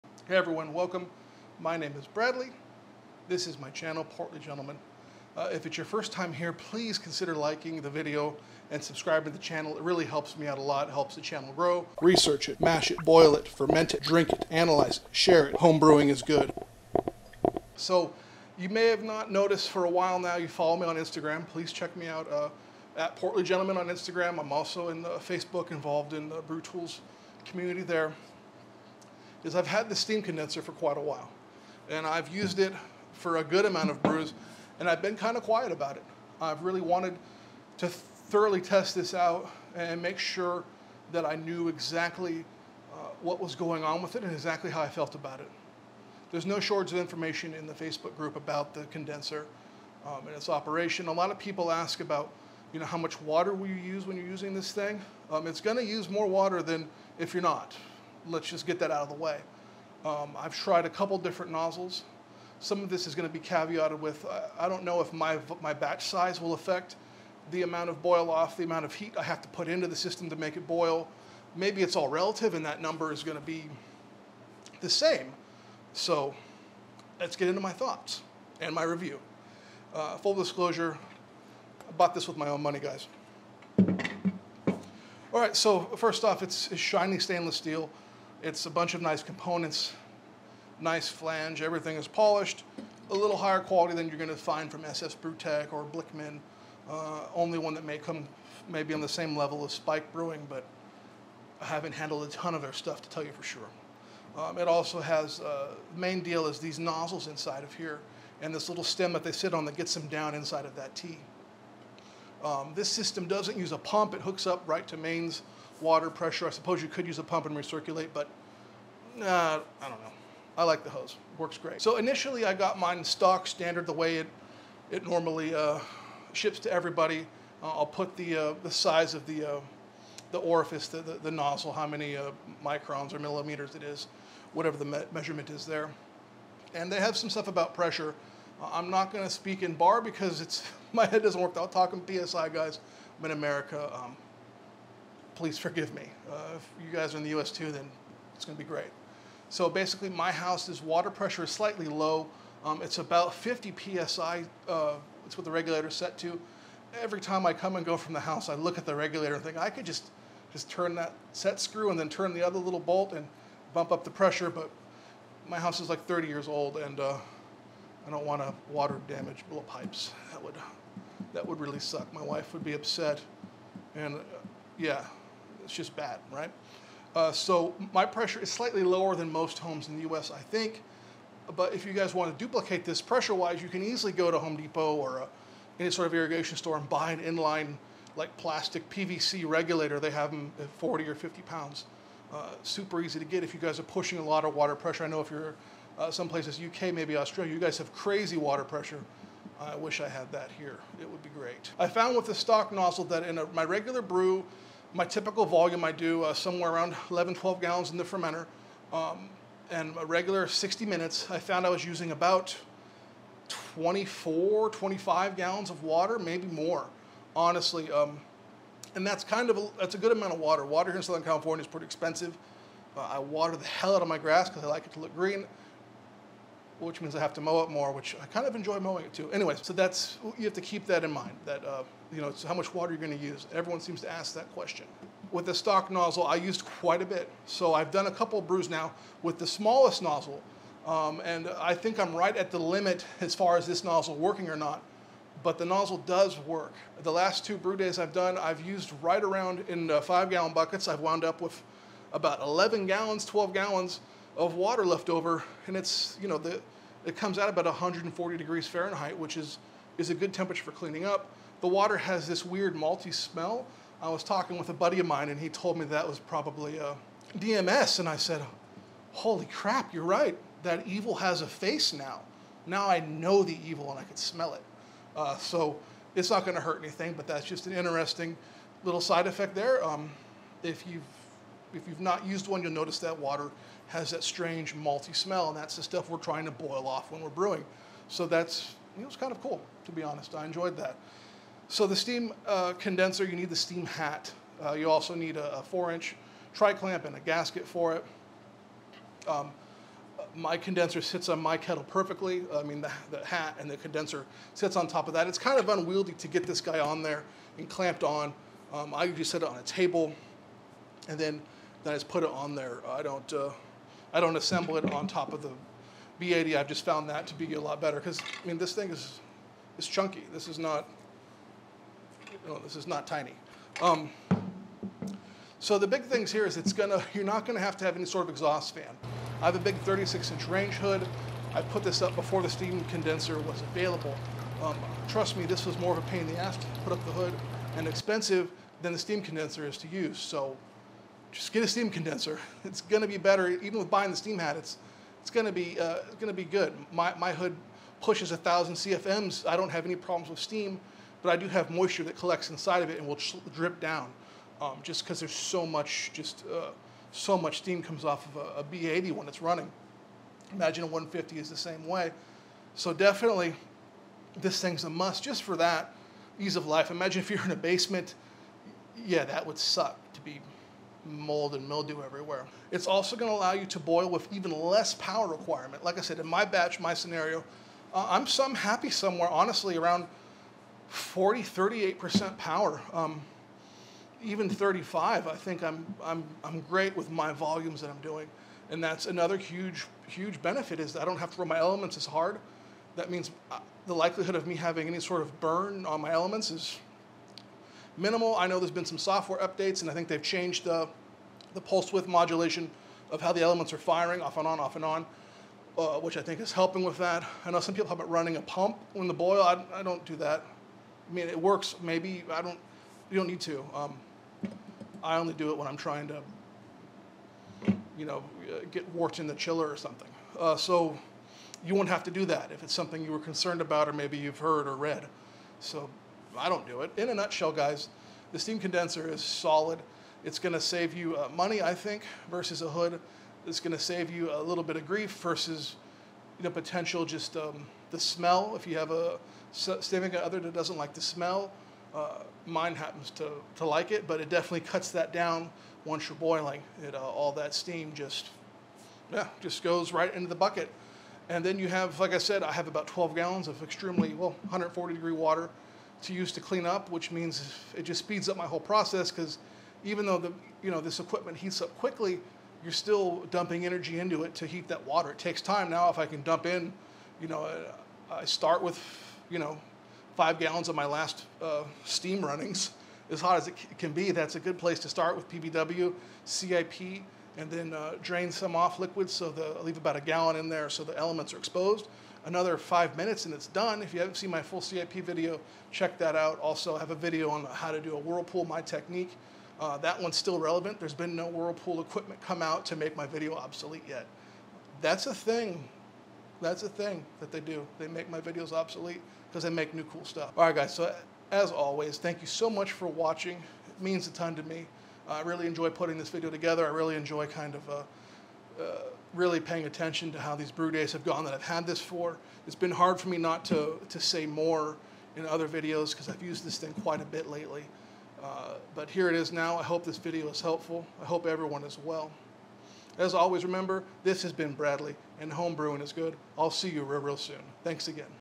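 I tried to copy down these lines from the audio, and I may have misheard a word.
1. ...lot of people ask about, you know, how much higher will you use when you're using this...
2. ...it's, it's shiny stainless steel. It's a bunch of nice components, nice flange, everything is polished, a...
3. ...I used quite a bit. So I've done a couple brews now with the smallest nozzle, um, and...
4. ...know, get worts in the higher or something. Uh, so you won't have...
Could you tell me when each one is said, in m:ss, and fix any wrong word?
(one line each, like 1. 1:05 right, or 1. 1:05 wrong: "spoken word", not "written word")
1. 0:51 wrong: "water", not "higher"
2. 1:26 right
3. 3:56 right
4. 6:58 wrong: "chiller", not "higher".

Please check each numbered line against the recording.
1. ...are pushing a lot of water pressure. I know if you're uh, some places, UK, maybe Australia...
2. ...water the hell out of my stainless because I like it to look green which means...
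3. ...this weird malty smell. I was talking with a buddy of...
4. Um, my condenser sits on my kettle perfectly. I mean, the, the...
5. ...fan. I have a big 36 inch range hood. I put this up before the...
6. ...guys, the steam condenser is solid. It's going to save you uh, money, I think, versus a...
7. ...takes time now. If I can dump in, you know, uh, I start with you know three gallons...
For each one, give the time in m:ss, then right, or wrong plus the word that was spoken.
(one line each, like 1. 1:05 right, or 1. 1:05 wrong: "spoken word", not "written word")
1. 3:13 right
2. 3:43 wrong: "grass", not "stainless"
3. 4:22 right
4. 4:59 right
5. 5:28 right
6. 7:07 right
7. 7:45 wrong: "five", not "three".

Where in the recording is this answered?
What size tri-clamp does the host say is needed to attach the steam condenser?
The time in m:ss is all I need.
4:55.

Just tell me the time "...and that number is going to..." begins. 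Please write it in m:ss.
1:12.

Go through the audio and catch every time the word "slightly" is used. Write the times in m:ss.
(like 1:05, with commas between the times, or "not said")
2:31, 2:58.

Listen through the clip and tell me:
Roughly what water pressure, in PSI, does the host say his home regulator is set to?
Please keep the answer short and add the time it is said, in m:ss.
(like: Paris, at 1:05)
50 psi, at 2:32.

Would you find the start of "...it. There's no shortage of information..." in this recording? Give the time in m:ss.
0:45.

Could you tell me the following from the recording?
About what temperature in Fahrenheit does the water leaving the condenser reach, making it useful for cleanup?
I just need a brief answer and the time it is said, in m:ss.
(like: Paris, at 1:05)
140 degrees Fahrenheit, at 4:17.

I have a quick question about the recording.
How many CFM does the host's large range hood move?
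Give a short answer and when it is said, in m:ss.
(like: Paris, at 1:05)
1,000 CFM, at 5:48.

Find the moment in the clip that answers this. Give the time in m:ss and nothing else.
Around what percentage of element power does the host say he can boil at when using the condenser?
6:21.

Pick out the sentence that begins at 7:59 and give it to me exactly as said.
So the, I leave about a gallon in there so the elements are exposed.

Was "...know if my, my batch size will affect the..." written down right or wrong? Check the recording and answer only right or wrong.
right.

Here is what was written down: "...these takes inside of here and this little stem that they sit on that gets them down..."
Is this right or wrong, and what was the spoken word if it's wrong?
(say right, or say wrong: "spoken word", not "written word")
wrong: "nozzles", not "takes".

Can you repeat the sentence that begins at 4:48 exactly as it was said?
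So that's, it was kind of cool, to be honest.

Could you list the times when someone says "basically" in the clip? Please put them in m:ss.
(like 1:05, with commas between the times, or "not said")
2:29.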